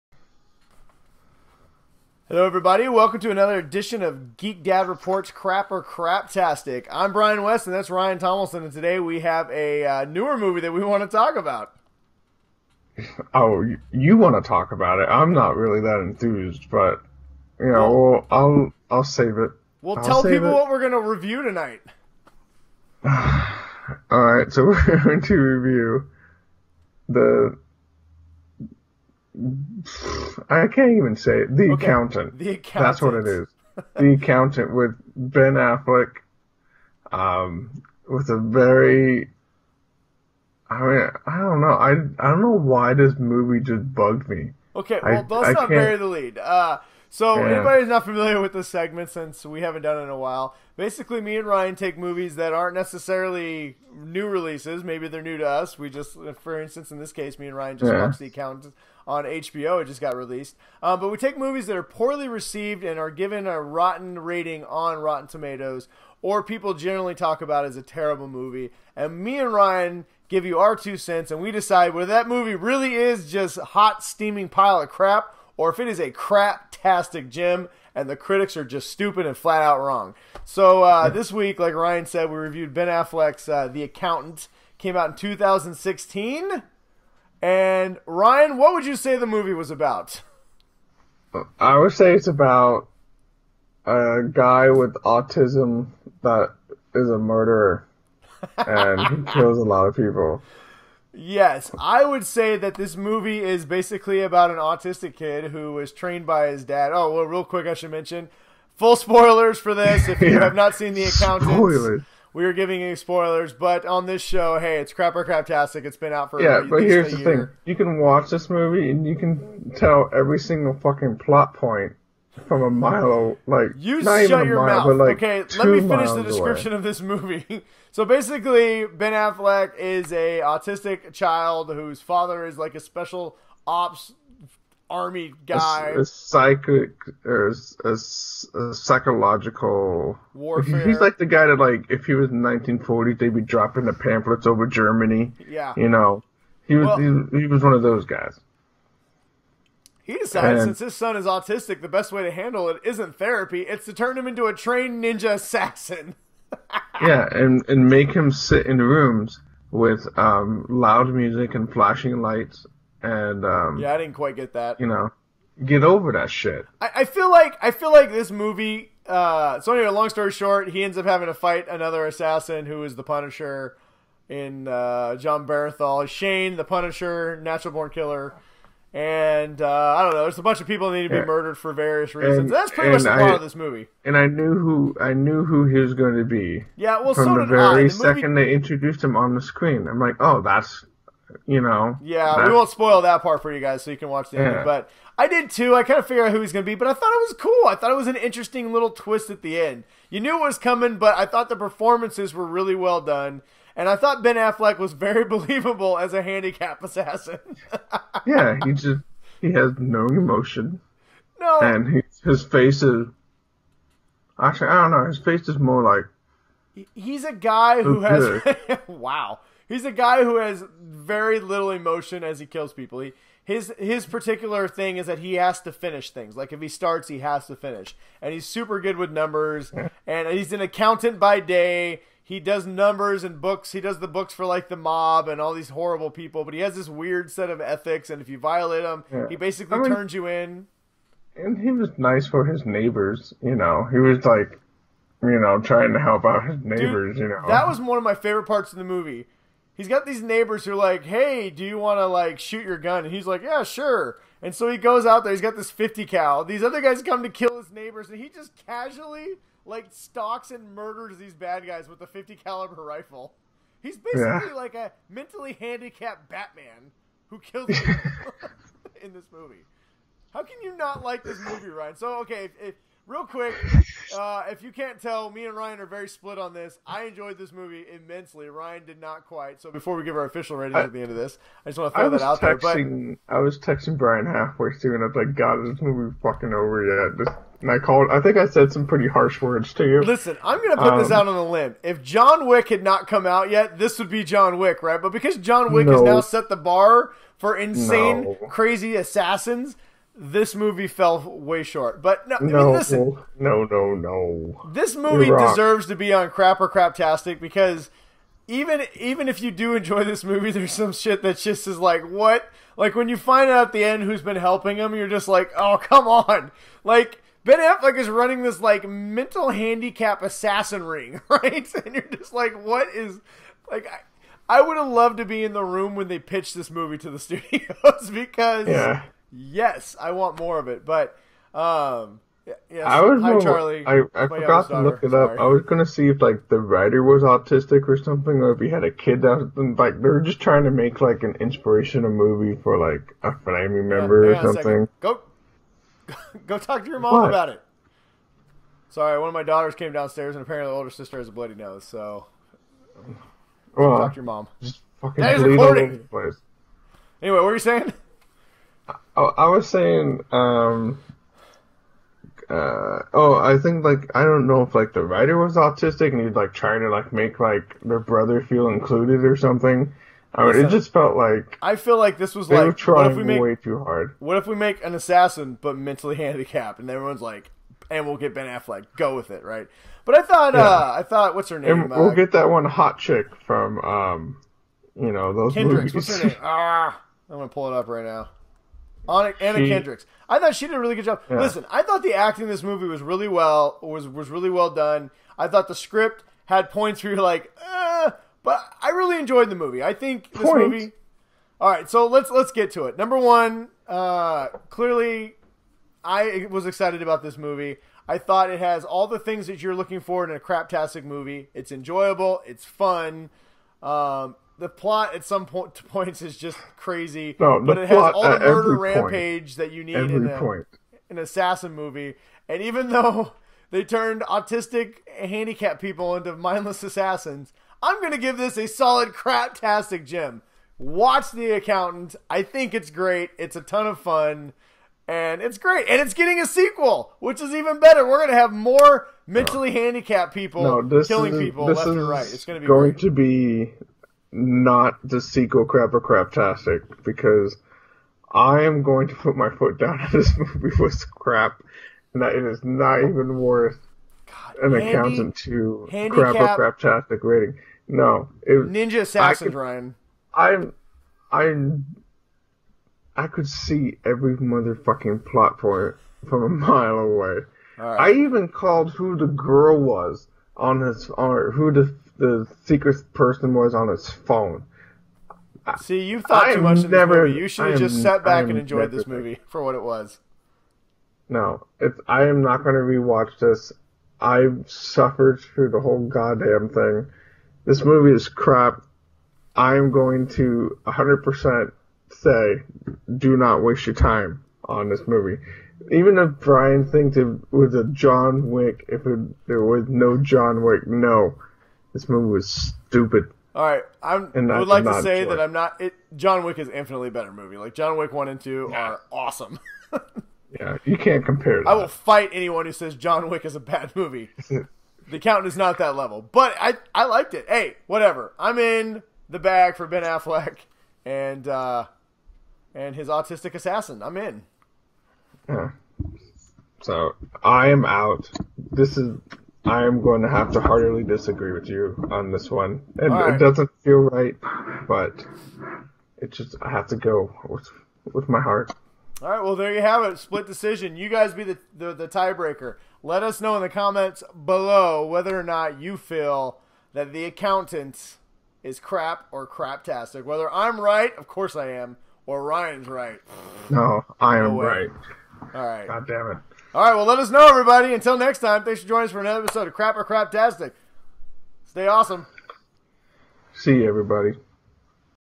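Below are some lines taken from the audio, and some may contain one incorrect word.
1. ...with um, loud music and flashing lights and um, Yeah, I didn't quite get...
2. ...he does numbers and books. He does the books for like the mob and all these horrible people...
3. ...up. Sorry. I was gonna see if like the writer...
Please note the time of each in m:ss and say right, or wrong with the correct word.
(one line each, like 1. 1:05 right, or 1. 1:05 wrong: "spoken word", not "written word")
1. 2:39 right
2. 3:52 right
3. 5:35 right.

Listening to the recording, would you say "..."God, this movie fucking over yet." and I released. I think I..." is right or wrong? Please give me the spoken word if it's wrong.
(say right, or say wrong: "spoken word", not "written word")
wrong: "called", not "released".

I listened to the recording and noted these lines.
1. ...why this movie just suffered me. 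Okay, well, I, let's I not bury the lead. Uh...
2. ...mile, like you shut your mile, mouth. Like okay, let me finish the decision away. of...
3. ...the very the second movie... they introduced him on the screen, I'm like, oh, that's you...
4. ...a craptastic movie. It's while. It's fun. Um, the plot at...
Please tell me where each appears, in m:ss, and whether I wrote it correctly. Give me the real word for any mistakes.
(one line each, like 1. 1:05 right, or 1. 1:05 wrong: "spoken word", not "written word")
1. 0:42 wrong: "bugged", not "suffered"
2. 2:02 wrong: "description", not "decision"
3. 3:07 right
4. 6:50 wrong: "enjoyable", not "while".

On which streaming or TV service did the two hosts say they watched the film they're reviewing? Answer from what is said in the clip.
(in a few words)
HBO.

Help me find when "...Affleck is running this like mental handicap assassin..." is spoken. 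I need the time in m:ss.
5:17.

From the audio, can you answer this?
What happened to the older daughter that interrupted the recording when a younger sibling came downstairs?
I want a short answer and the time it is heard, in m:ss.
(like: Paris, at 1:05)
A bloody nose, at 5:51.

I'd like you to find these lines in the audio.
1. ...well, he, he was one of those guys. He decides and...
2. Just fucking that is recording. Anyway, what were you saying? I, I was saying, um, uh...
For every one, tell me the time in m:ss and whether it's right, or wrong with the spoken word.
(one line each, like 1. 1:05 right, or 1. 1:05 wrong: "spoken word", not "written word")
1. 2:26 right
2. 5:54 right.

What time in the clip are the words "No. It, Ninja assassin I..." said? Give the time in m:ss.
7:37.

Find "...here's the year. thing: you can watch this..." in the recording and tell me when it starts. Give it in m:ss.
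1:56.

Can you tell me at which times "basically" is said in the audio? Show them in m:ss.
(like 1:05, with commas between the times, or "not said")
0:50, 1:43, 2:08, 3:59, 4:23.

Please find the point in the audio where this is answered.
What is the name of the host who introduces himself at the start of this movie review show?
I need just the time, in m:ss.
0:07.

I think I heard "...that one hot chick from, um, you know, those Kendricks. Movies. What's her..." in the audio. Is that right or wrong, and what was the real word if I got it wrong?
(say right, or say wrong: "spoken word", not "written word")
right.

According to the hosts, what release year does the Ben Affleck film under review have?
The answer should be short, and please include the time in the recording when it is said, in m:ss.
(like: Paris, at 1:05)
2016, at 1:25.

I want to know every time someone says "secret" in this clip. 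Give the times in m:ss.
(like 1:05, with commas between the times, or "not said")
7:52.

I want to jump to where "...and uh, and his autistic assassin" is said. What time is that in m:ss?
8:41.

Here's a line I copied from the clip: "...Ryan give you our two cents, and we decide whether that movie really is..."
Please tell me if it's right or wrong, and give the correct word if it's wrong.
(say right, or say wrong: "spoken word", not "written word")
right.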